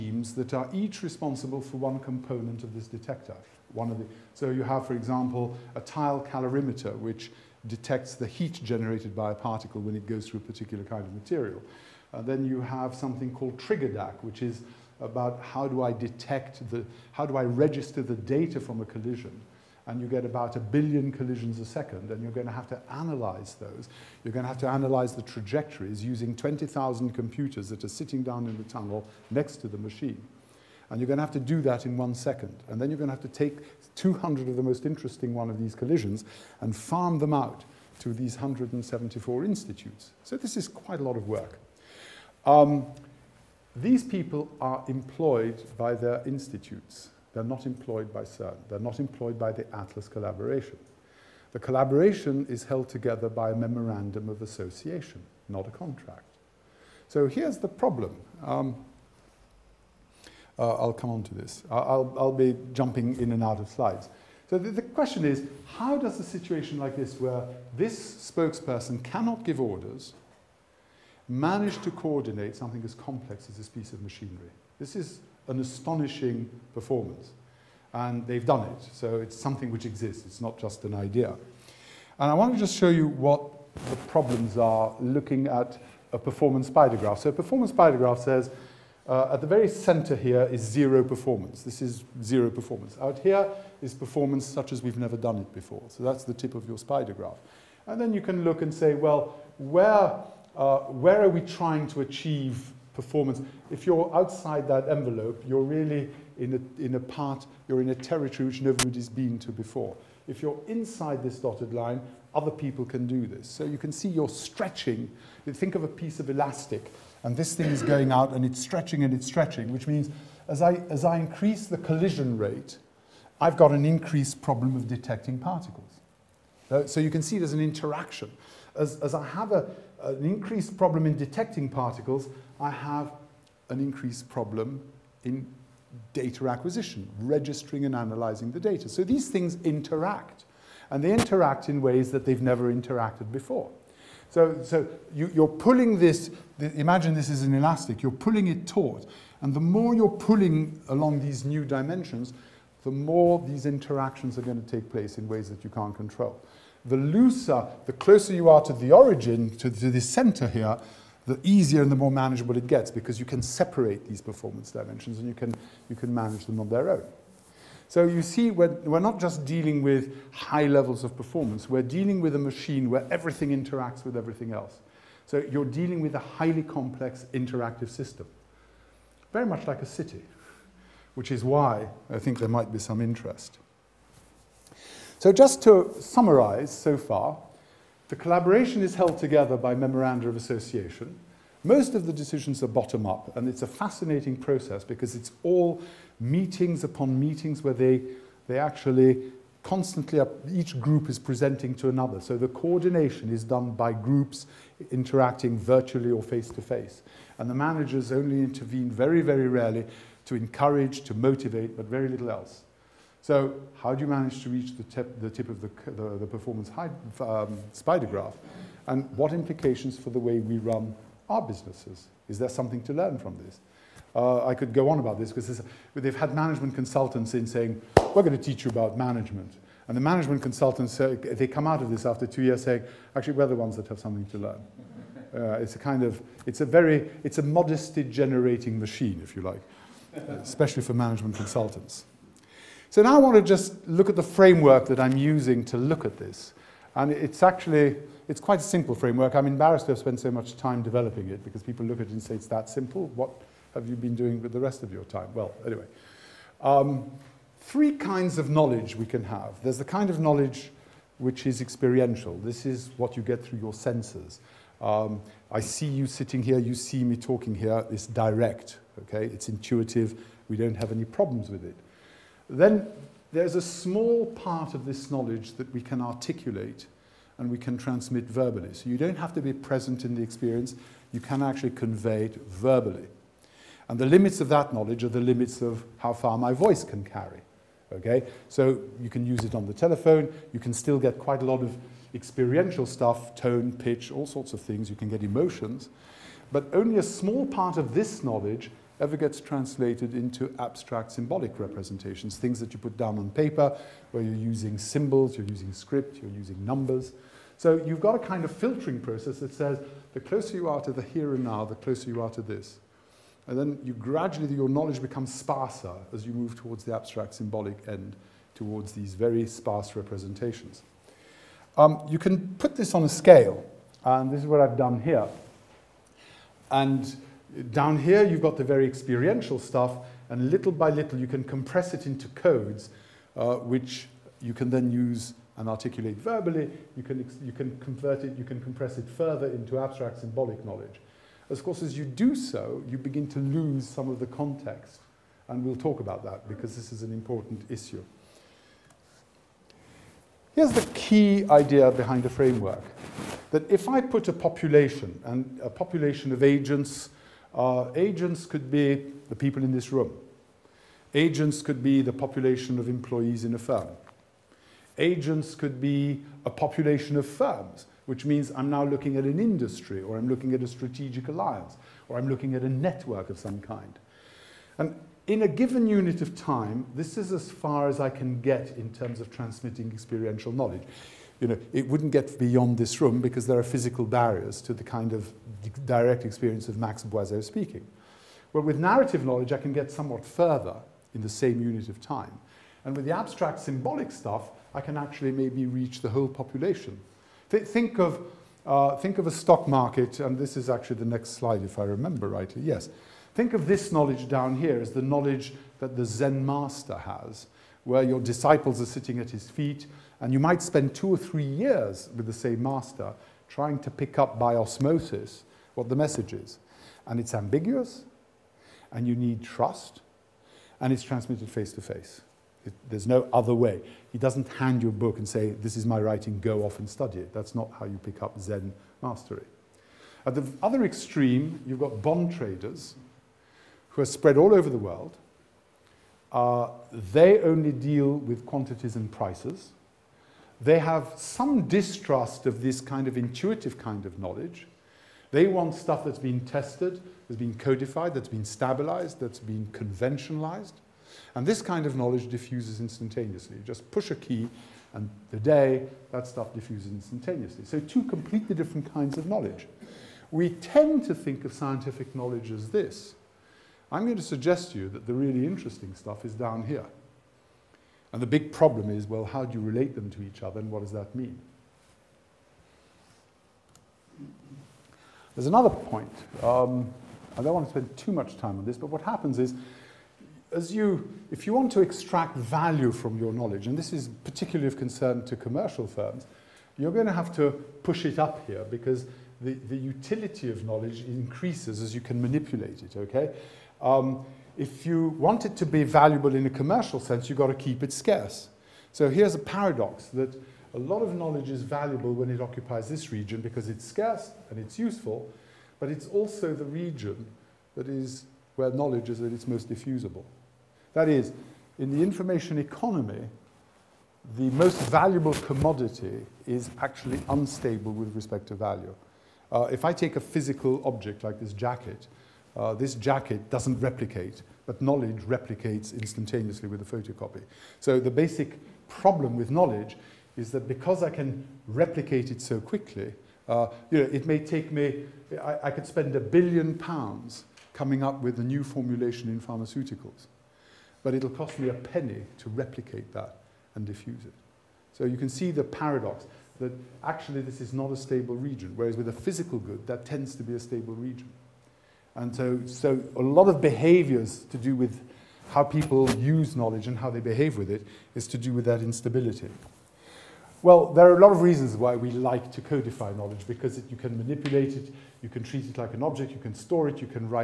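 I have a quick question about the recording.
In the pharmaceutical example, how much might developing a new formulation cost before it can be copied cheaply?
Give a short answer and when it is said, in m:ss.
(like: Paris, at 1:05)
a billion pounds, at 8:56.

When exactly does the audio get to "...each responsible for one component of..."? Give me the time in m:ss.
0:00.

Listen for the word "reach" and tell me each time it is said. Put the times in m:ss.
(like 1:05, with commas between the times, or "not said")
3:34, 6:35.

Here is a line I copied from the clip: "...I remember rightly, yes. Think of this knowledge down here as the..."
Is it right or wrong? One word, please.
right.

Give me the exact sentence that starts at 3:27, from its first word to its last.
And the managers only intervene very, very rarely to encourage, to motivate, but very little else.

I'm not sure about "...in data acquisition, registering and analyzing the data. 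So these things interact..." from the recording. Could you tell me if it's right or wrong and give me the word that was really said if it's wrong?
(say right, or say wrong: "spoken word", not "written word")
right.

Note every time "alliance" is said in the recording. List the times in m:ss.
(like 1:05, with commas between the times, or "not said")
6:11.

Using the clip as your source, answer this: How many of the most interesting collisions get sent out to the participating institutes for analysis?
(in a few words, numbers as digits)
200.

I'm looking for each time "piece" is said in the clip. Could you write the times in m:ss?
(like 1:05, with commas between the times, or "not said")
1:13, 1:55.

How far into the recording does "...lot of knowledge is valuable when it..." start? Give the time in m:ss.
8:20.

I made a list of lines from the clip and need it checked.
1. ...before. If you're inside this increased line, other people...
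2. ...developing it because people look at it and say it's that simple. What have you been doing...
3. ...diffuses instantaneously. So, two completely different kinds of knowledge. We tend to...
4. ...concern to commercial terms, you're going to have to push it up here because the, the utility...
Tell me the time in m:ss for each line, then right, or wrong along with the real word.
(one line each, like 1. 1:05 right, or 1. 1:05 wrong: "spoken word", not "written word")
1. 1:49 wrong: "dotted", not "increased"
2. 4:10 right
3. 7:36 right
4. 8:04 wrong: "firms", not "terms".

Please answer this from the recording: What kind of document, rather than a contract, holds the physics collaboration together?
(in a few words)
memorandum of association.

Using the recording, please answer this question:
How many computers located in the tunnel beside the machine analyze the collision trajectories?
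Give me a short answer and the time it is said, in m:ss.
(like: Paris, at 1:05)
20,000, at 0:26.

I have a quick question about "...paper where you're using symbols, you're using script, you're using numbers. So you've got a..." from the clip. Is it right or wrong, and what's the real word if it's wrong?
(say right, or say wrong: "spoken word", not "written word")
right.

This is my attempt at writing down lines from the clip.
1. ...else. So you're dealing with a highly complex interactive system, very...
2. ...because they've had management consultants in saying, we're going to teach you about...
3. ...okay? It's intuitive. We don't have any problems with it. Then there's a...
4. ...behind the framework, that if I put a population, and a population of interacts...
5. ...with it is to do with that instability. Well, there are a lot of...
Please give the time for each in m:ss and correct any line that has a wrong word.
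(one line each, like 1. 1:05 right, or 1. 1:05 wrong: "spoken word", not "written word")
1. 2:54 right
2. 3:45 right
3. 4:29 right
4. 5:51 wrong: "agents", not "interacts"
5. 9:17 right.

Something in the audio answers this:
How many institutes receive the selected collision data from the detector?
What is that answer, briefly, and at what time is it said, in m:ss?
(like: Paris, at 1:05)
174, at 0:38.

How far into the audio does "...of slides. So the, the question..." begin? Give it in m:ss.
1:03.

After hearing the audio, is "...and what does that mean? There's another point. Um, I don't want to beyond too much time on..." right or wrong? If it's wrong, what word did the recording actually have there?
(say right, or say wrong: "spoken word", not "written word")
wrong: "spend", not "beyond".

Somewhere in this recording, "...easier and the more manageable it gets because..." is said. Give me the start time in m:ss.
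2:41.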